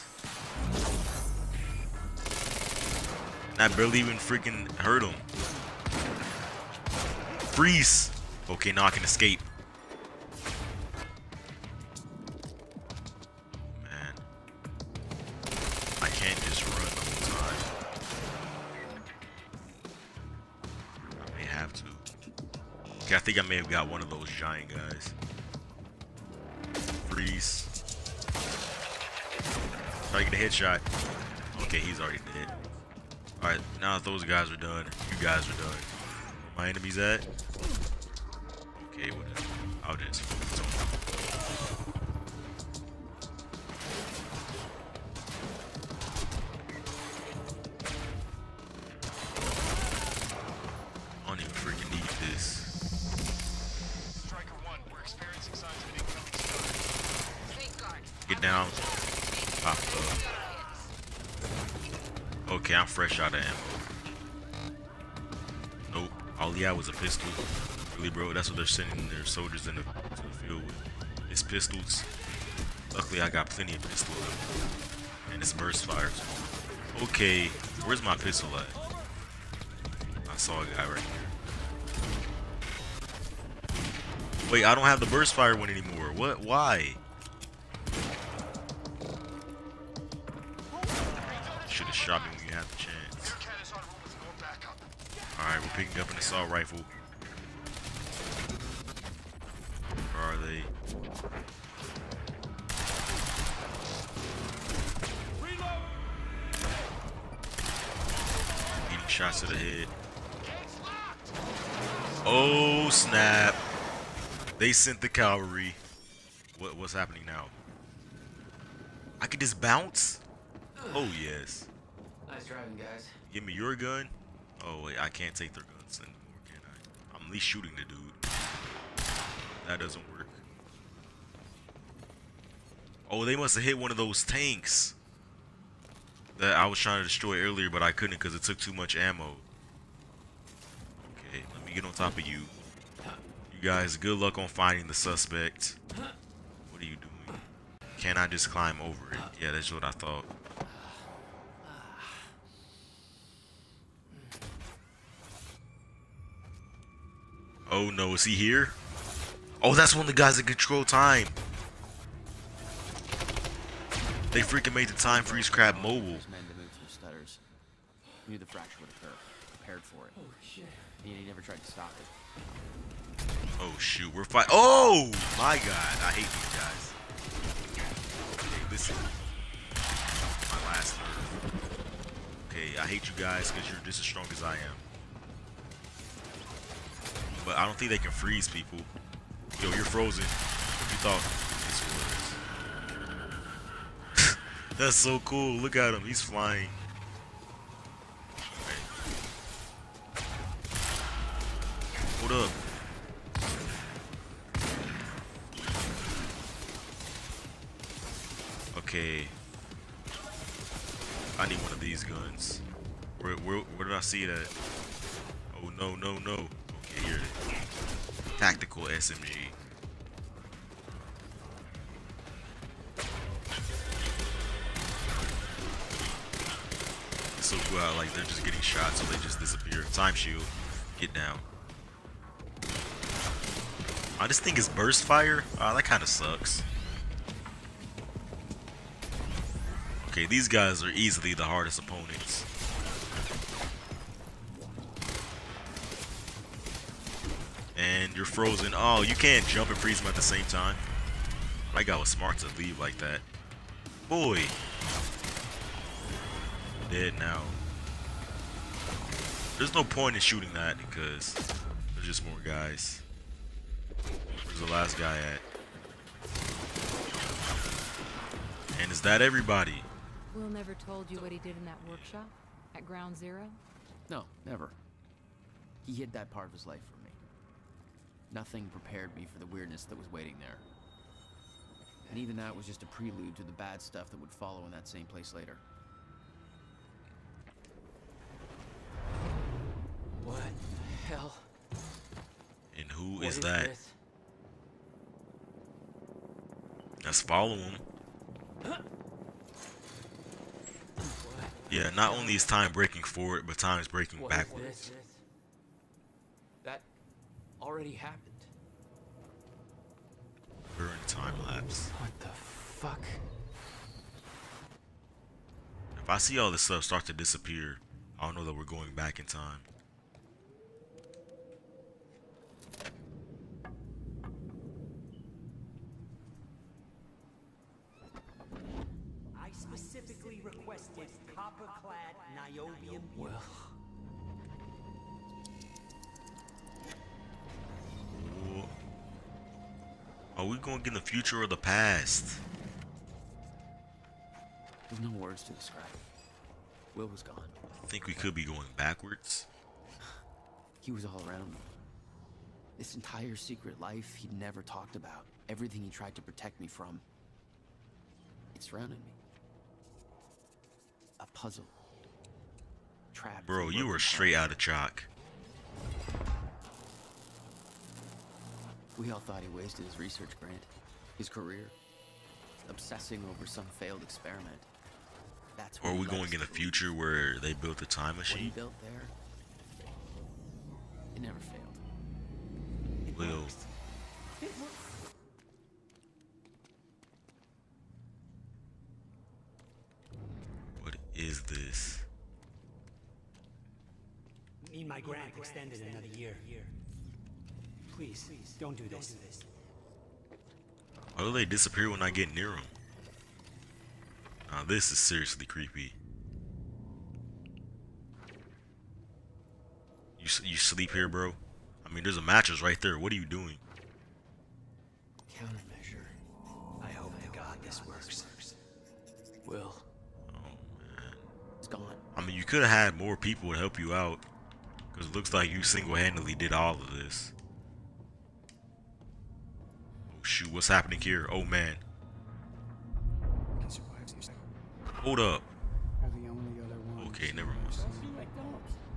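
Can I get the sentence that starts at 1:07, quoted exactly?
Really, bro, that's what they're sending their soldiers in the, to the field with.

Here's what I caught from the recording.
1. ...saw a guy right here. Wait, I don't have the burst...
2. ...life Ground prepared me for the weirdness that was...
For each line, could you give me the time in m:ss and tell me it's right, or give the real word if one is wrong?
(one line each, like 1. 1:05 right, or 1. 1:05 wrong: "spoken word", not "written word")
1. 1:20 right
2. 4:36 wrong: "Nothing", not "Ground".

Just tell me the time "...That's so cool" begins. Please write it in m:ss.
3:14.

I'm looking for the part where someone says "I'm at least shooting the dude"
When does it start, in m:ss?
2:07.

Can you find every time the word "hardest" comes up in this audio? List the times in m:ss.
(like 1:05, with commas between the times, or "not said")
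4:01.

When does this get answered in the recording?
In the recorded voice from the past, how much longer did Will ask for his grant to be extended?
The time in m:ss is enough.
6:35.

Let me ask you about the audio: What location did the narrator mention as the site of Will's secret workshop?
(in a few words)
Ground Zero.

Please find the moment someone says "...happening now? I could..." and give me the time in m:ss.
1:56.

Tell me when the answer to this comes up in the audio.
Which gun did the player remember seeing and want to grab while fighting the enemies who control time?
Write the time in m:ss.
3:38.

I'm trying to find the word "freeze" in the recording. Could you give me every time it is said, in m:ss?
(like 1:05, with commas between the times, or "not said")
0:07, 0:27, 2:45, 3:08, 4:09.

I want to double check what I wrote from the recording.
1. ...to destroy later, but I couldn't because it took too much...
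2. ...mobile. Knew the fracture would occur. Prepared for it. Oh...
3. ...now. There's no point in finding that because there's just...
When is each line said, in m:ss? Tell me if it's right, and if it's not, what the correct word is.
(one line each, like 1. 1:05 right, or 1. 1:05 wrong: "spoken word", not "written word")
1. 2:16 wrong: "earlier", not "later"
2. 2:45 right
3. 4:17 wrong: "shooting", not "finding".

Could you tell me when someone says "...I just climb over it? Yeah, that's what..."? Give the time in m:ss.
2:28.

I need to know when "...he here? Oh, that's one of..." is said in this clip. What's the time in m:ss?
2:38.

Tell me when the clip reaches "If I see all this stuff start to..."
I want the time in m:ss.
5:15.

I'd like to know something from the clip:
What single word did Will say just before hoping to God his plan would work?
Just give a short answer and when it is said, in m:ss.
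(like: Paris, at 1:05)
Countermeasure, at 6:55.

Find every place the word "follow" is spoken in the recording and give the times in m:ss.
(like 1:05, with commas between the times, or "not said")
4:44, 4:57.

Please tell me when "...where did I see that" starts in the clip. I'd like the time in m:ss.
3:33.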